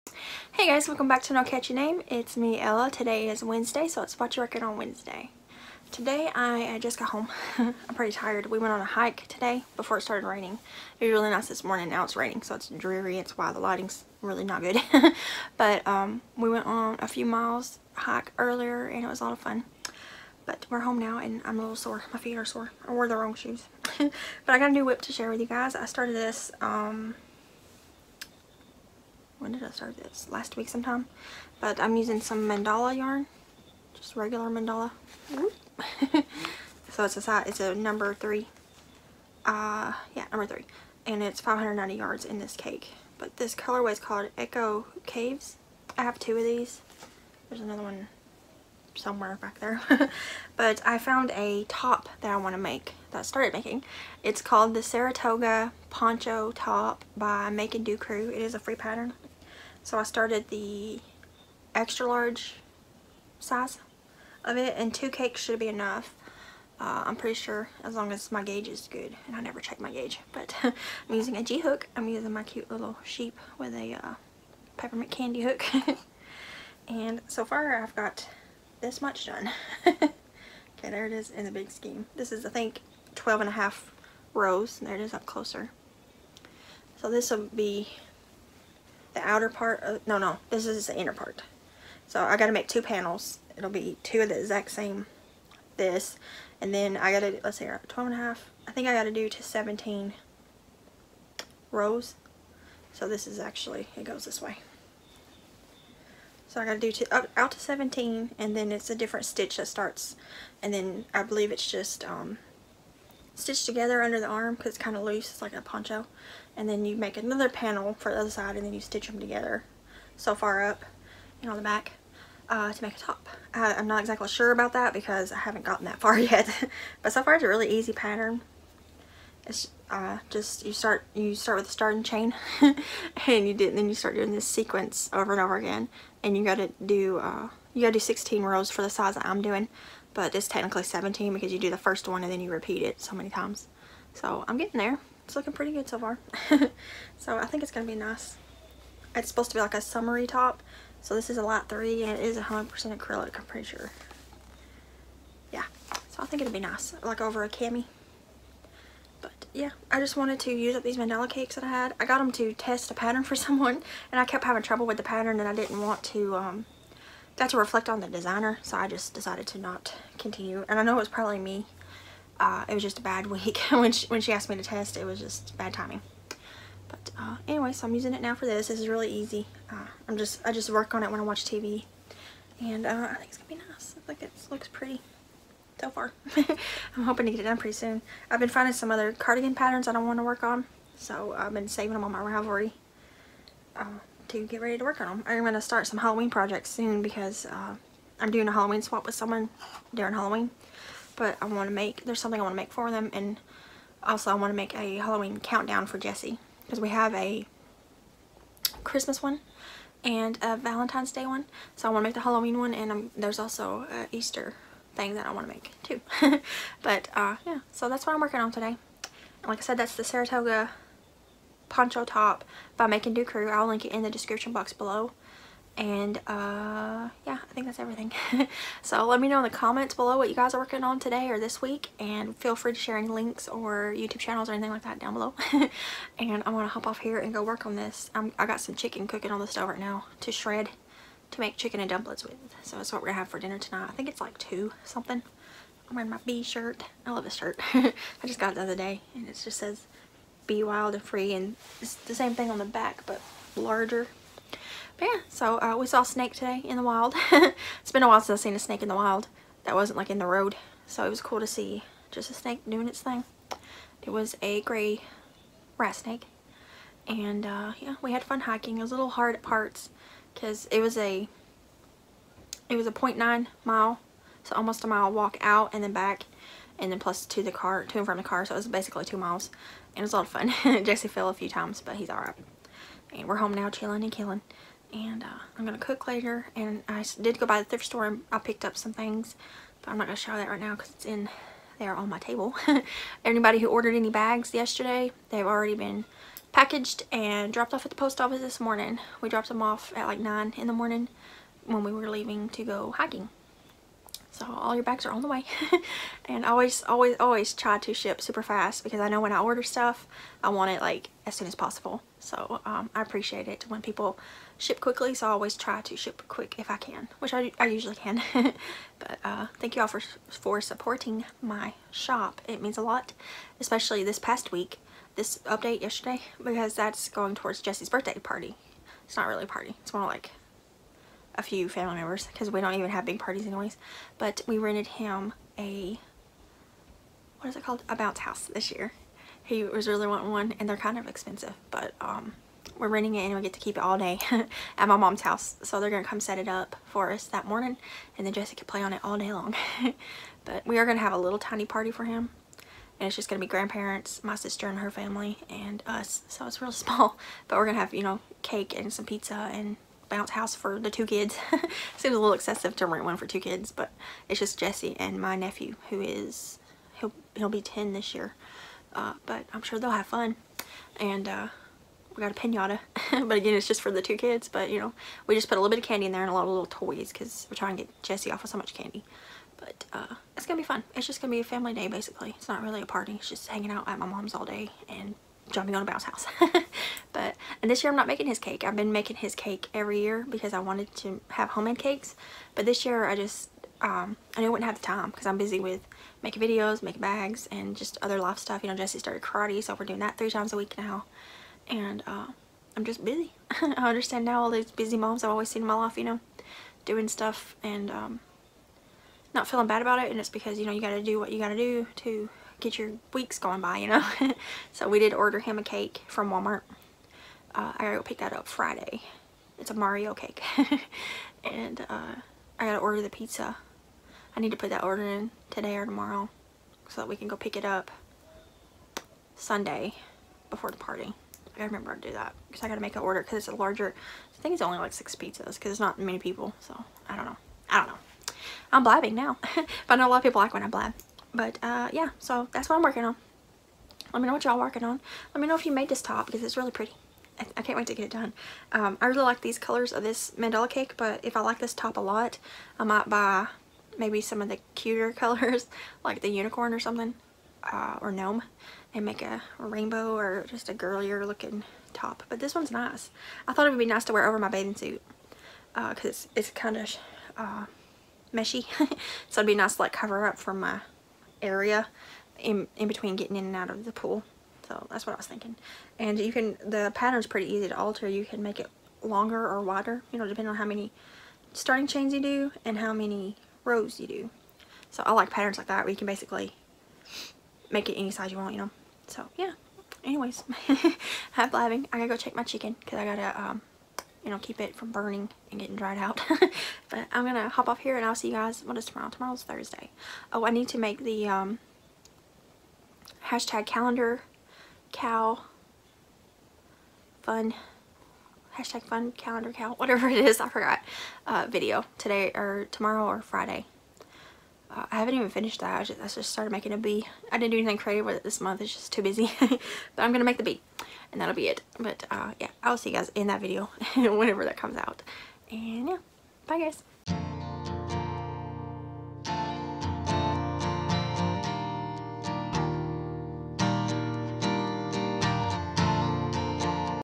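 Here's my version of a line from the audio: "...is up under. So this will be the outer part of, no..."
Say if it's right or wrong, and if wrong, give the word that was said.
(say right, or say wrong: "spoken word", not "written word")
wrong: "closer", not "under".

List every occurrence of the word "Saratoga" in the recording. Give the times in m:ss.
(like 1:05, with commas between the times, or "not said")
0:54, 3:40.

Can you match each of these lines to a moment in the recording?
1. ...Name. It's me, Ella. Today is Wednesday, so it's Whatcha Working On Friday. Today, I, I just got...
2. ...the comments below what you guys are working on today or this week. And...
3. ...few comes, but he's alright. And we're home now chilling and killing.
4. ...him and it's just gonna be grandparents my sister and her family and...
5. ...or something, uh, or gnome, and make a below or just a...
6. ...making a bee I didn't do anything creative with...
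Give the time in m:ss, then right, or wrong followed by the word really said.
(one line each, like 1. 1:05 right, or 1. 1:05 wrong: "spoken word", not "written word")
1. 0:01 wrong: "Wednesday", not "Friday"
2. 3:49 right
3. 4:41 wrong: "times", not "comes"
4. 5:52 right
5. 7:36 wrong: "rainbow", not "below"
6. 8:36 right.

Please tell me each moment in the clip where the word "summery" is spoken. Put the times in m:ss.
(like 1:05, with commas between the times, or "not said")
2:29.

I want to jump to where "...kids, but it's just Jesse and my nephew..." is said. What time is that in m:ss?
6:03.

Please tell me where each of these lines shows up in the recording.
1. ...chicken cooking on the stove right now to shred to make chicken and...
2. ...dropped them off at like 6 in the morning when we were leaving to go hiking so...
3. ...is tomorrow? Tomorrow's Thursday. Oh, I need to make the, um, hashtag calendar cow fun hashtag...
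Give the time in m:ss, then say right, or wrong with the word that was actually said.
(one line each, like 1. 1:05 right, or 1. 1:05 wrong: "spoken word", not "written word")
1. 3:58 right
2. 4:59 wrong: "9", not "6"
3. 8:18 right.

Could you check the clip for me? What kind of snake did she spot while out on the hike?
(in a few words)
Gray rat snake.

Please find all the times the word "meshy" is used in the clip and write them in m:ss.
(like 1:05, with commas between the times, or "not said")
7:48.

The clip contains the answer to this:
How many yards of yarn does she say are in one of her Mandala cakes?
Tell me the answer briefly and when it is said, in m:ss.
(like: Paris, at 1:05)
590, at 0:41.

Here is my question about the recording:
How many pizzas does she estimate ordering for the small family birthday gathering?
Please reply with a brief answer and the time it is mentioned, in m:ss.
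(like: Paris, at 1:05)
6, at 7:14.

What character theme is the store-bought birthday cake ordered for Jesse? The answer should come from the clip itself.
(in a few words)
Mario.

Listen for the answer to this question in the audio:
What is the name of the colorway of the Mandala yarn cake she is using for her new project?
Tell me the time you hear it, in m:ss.
0:44.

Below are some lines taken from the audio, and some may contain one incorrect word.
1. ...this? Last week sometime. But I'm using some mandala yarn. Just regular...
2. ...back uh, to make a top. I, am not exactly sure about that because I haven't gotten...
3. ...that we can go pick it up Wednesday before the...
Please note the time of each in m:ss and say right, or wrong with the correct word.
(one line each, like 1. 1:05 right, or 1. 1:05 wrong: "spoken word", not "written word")
1. 0:29 right
2. 2:01 right
3. 7:07 wrong: "Sunday", not "Wednesday".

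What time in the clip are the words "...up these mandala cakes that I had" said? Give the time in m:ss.
2:40.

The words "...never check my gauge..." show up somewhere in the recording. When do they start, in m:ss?
1:09.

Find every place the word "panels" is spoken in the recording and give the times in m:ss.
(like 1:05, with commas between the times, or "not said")
1:32, 1:57.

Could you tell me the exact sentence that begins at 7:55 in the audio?
And you can, the pattern's pretty easy to alter.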